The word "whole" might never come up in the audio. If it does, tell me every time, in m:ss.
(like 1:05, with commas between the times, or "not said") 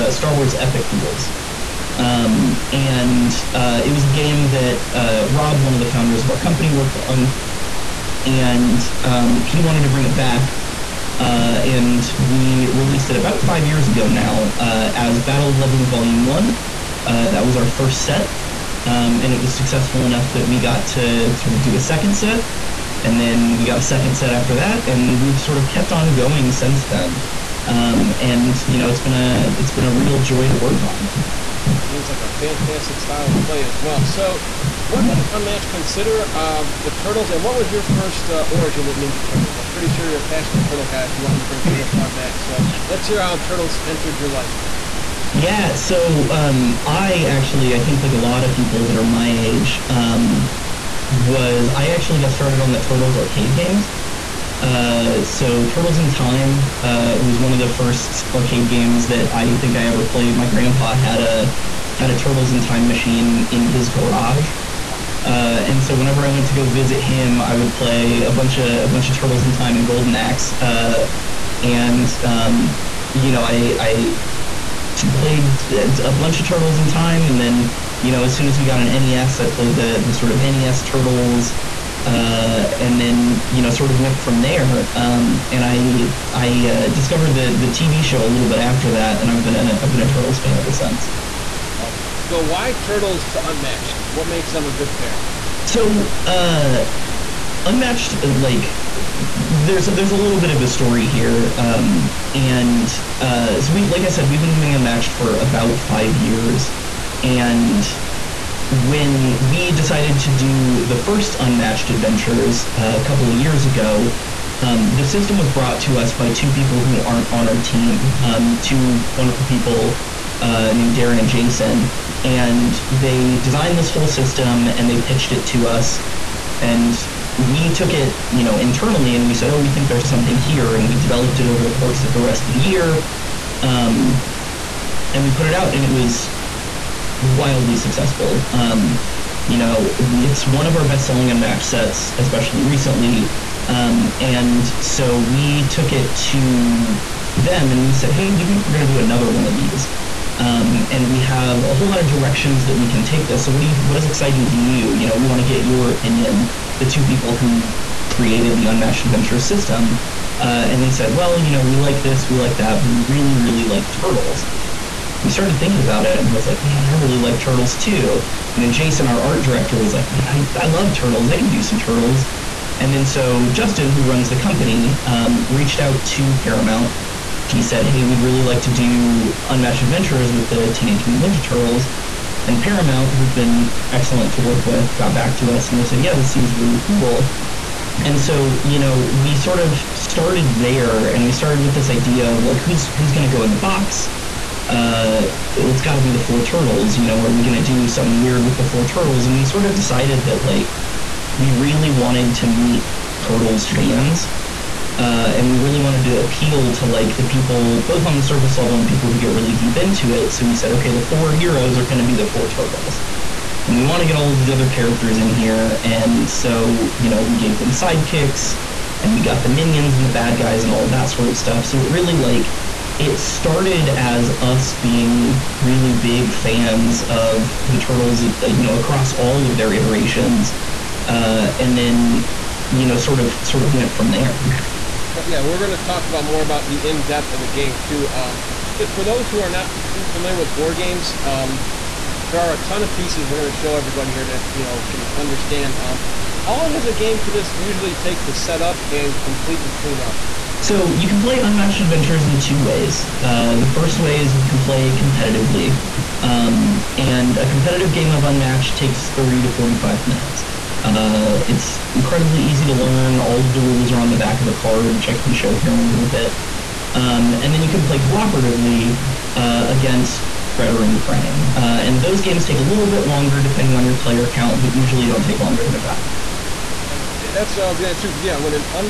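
2:03, 2:31.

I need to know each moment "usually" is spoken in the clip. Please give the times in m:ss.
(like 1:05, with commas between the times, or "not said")
4:07, 4:34.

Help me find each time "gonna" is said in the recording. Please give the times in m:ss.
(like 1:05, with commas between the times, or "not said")
4:37.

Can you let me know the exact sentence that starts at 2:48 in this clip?
And then Jason, our art director, was like, man, I, I love turtles.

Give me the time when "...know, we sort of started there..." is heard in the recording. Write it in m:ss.
3:08.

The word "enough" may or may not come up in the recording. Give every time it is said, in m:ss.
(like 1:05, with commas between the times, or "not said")
0:20.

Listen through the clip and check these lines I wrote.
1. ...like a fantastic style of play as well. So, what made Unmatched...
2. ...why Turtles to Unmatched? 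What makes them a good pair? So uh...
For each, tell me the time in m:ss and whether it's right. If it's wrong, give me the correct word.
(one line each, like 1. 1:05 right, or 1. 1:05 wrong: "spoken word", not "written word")
1. 0:32 right
2. 1:32 right.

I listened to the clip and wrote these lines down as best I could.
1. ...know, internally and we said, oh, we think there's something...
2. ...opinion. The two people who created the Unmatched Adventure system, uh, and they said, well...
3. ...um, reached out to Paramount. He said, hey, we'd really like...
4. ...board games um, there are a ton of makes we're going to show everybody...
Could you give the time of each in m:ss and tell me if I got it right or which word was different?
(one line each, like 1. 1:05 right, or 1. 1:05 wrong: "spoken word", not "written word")
1. 2:08 right
2. 2:35 right
3. 2:55 right
4. 4:00 wrong: "pieces", not "makes".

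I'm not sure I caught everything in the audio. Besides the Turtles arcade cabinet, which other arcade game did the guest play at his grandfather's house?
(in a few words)
Golden Axe.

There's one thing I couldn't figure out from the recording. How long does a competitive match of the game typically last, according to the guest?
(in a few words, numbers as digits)
30 to 45 minutes.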